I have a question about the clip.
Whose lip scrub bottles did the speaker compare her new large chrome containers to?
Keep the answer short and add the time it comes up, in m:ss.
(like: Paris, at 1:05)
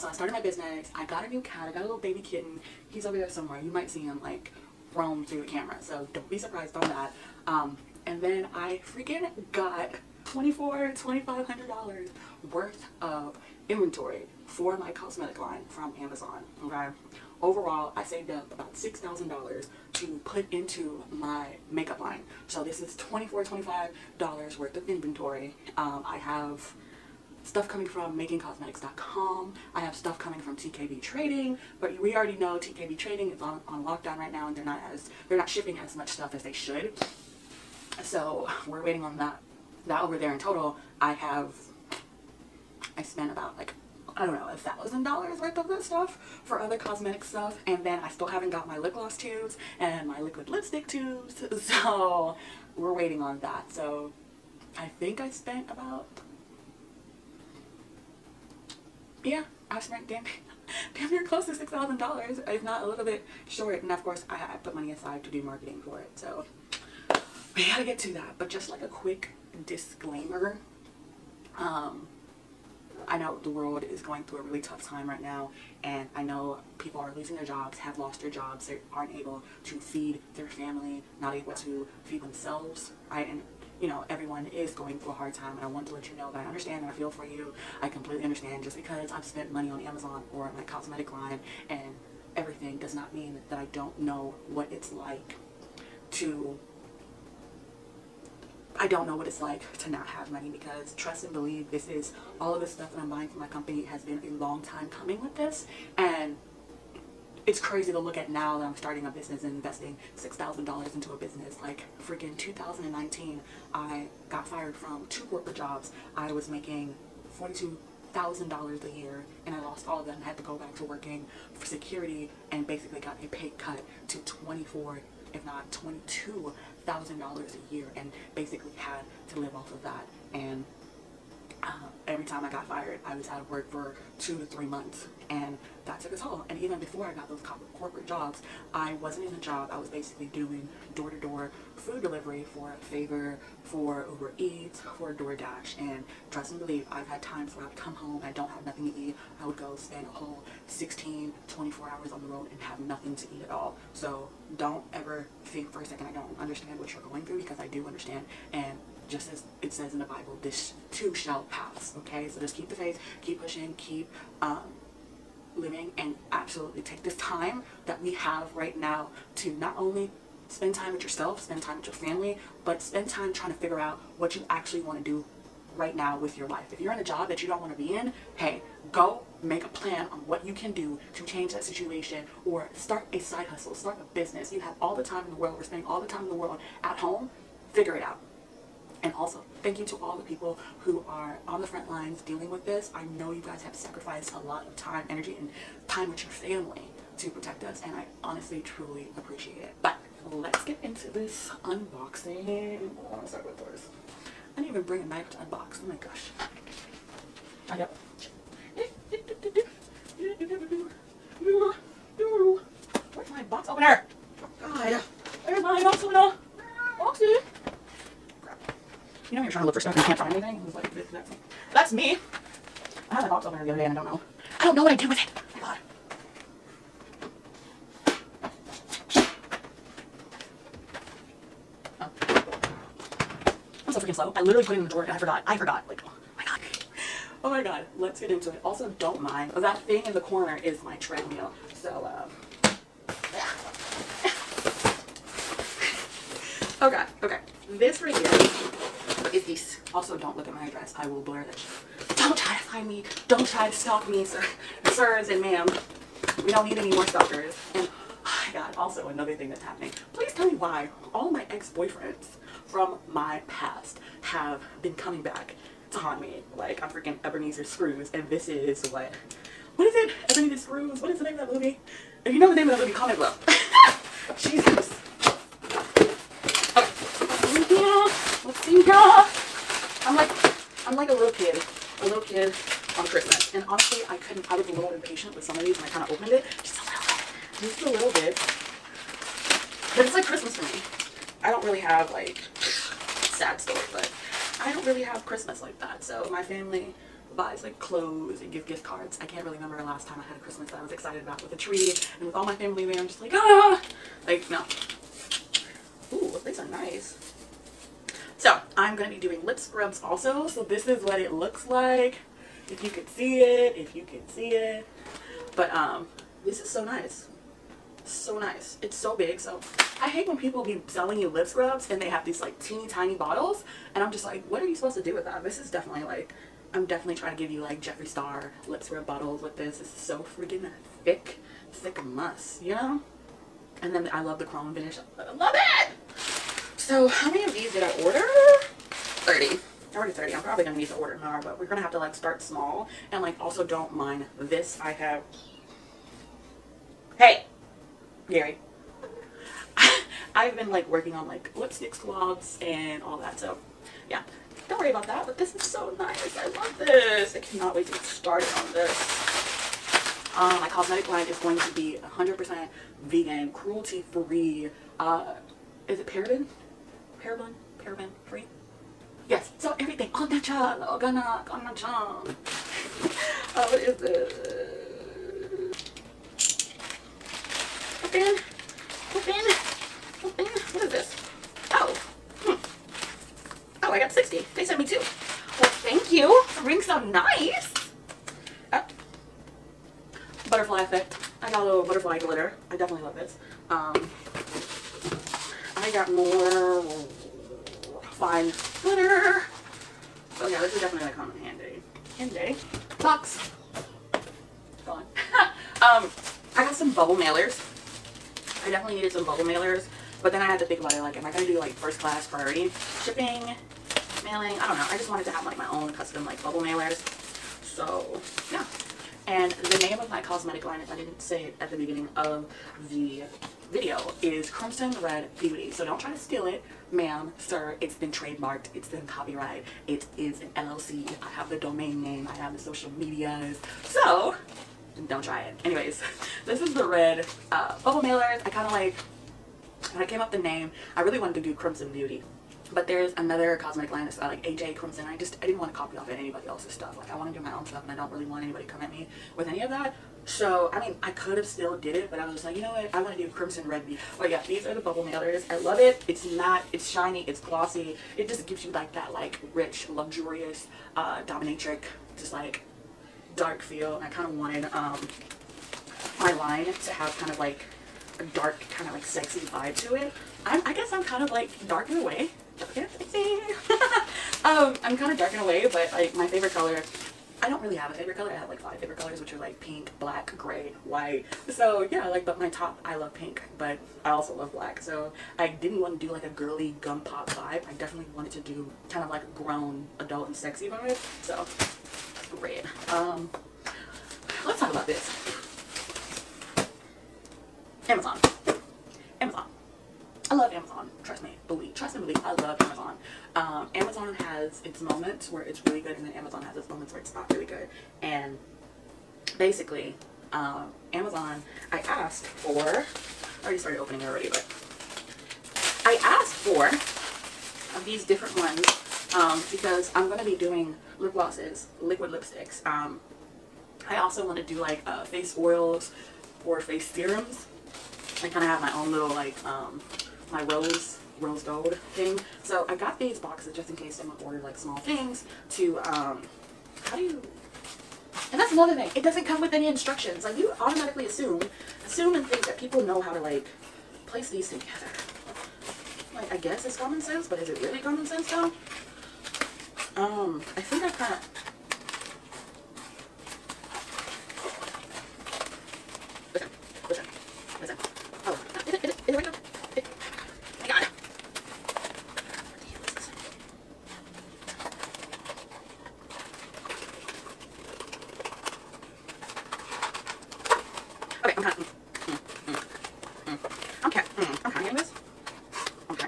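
Jeffree Star, at 5:27.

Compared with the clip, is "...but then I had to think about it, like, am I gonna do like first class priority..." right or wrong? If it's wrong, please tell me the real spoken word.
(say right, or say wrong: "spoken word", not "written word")
right.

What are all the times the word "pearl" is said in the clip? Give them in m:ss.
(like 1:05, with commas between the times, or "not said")
not said.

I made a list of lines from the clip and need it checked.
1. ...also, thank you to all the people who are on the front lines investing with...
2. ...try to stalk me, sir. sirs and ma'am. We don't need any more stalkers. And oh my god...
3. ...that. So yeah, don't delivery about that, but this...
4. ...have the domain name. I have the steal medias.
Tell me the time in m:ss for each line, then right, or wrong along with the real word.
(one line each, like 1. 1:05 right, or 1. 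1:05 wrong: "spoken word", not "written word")
1. 3:09 wrong: "dealing", not "investing"
2. 4:13 right
3. 5:53 wrong: "worry", not "delivery"
4. 7:11 wrong: "social", not "steal".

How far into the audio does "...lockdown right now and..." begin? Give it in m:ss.
0:33.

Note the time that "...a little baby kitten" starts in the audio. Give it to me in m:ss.
0:01.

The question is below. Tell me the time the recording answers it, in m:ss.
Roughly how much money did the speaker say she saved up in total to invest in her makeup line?
0:18.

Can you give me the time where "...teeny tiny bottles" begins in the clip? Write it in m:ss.
5:22.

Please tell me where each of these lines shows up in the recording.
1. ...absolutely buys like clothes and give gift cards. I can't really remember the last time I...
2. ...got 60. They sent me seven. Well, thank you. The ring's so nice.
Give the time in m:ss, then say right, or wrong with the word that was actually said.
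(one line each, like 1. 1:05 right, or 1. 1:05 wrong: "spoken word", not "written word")
1. 4:56 wrong: "family", not "absolutely"
2. 6:23 wrong: "two", not "seven".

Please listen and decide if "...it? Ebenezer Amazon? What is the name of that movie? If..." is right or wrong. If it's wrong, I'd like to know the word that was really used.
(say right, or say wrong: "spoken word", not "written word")
wrong: "Screws", not "Amazon".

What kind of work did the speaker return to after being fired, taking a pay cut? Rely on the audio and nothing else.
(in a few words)
security.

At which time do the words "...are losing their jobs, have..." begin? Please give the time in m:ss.
1:17.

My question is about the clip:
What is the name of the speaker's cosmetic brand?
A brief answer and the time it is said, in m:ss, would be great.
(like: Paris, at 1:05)
Crimson Red Beauty, at 7:04.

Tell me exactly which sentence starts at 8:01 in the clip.
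So yeah, like, but my top, I love pink, but I also love black.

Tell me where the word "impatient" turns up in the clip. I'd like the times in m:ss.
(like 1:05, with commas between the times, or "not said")
4:44.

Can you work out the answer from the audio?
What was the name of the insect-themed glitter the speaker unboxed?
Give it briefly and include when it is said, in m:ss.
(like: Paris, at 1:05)
butterfly effect, at 6:30.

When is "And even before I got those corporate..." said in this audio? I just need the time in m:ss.
2:16.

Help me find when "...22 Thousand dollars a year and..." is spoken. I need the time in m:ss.
2:05.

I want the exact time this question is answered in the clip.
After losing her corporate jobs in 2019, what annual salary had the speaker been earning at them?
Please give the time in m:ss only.
1:57.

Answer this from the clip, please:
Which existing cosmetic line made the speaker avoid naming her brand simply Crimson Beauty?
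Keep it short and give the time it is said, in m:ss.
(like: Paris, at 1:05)
AJ Crimson, at 7:24.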